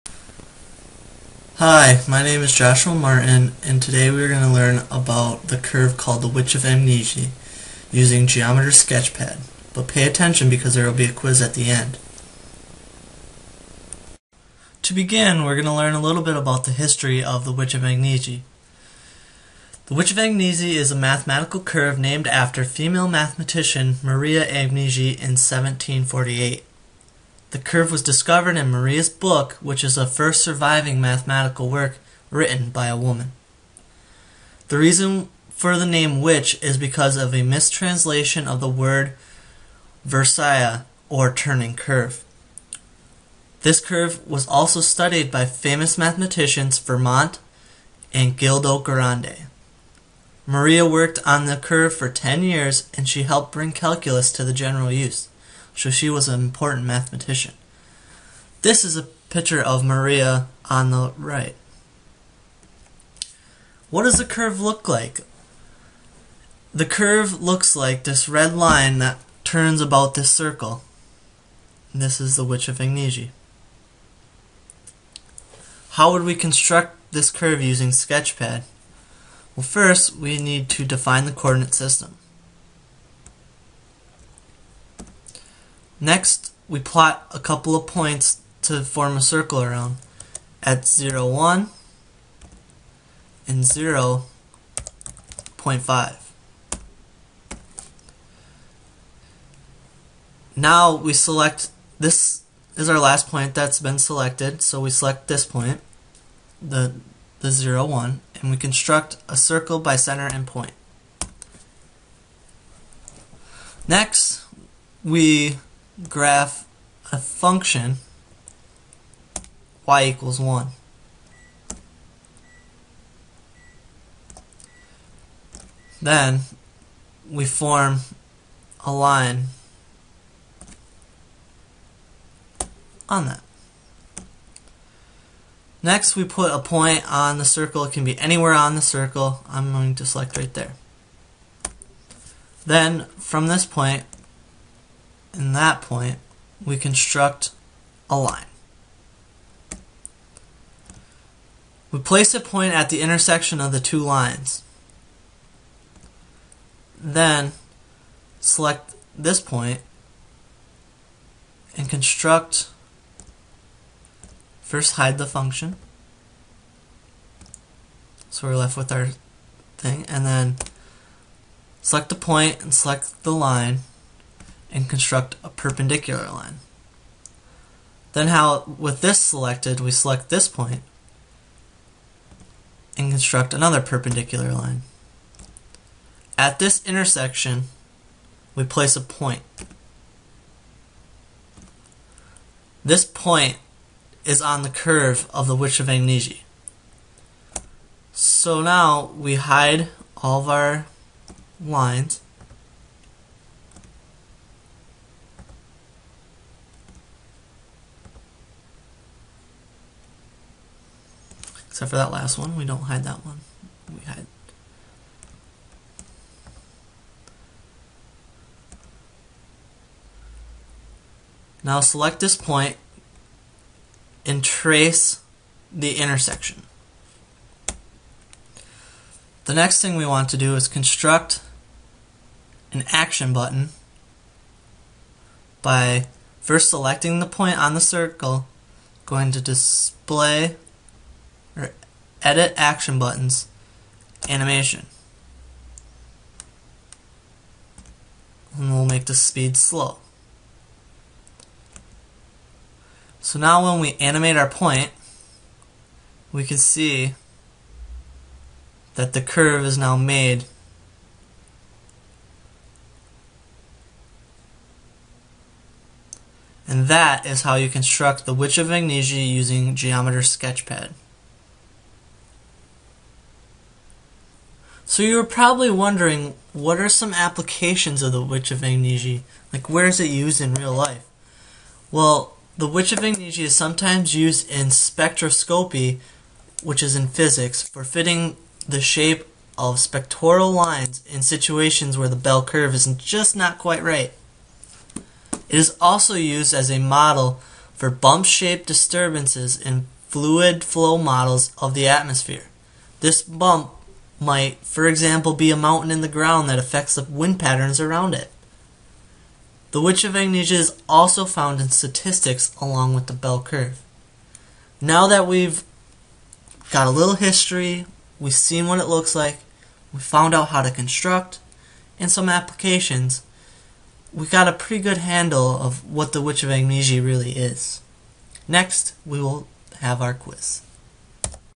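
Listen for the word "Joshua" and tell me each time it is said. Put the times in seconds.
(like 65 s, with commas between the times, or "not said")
2 s.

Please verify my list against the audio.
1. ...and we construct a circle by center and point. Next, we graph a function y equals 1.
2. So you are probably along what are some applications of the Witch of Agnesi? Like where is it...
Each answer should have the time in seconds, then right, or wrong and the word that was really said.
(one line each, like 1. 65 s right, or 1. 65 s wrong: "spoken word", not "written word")
1. 108 s right
2. 274 s wrong: "wondering", not "along".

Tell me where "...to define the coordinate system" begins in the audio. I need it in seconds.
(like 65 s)
80 s.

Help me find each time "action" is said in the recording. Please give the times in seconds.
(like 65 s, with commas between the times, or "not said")
232 s, 242 s.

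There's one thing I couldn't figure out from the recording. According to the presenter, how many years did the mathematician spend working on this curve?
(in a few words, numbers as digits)
10.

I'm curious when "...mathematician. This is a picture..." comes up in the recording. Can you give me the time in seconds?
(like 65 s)
56 s.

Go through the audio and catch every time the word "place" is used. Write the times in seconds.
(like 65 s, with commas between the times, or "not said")
151 s, 188 s.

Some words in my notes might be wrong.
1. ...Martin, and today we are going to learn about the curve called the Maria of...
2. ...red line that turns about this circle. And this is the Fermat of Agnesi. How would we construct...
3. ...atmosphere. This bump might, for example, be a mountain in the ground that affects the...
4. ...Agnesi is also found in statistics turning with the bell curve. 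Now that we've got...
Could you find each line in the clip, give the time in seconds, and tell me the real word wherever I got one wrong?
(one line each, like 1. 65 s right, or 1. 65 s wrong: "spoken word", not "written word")
1. 2 s wrong: "Witch", not "Maria"
2. 68 s wrong: "Witch", not "Fermat"
3. 301 s right
4. 310 s wrong: "along", not "turning".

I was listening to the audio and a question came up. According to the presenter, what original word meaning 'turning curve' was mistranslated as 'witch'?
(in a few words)
versia.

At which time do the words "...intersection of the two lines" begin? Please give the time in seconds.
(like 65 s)
153 s.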